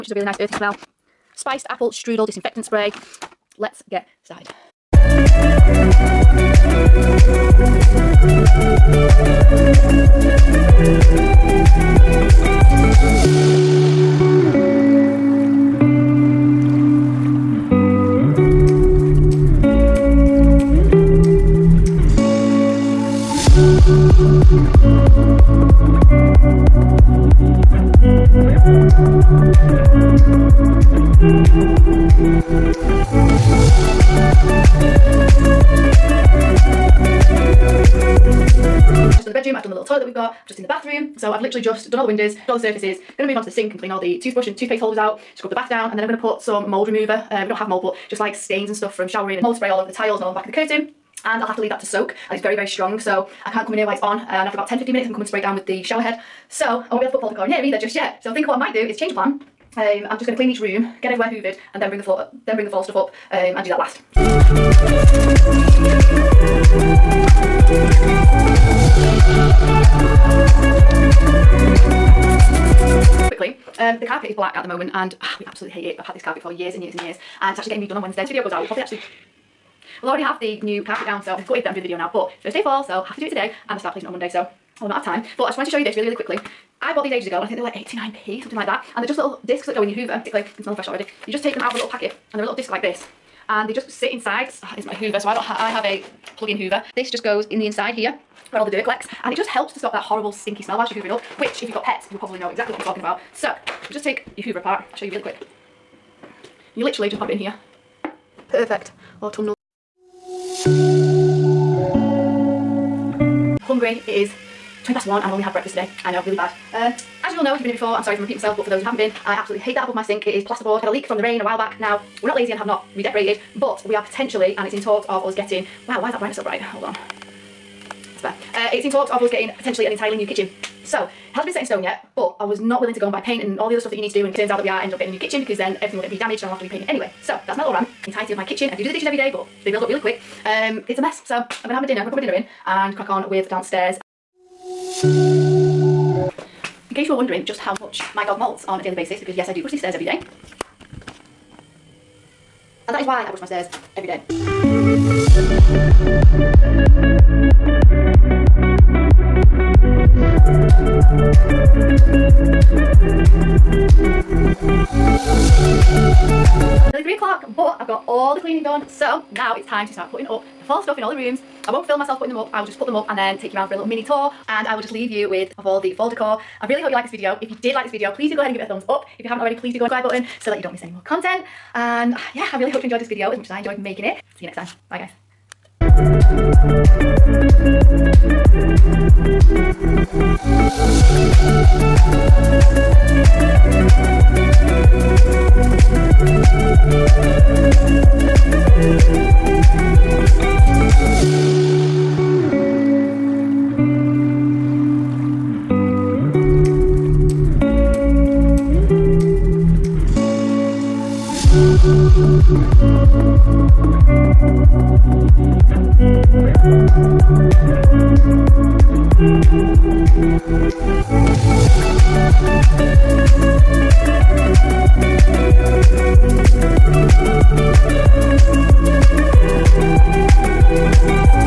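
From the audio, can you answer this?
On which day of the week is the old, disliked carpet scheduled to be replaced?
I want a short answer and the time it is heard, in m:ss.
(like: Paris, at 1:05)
Wednesday, at 1:18.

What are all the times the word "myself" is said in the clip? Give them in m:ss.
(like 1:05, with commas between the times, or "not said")
1:58, 2:51.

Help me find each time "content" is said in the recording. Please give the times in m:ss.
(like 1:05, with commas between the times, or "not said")
3:01.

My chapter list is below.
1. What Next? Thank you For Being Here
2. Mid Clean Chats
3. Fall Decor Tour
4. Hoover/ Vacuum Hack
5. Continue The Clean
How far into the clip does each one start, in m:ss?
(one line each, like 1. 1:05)
1. 2:46
2. 1:53
3. 3:05
4. 1:13
5. 2:24.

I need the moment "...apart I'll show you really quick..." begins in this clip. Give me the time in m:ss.
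1:44.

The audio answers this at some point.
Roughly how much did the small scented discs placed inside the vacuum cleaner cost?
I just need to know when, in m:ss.
1:27.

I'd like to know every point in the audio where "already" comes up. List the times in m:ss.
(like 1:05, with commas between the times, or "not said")
1:20, 1:30, 2:59.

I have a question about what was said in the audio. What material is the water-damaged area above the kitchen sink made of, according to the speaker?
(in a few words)
Plasterboard.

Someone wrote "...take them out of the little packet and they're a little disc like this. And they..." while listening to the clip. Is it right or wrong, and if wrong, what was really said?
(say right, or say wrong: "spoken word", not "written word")
right.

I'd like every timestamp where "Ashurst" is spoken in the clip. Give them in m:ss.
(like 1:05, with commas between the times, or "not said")
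not said.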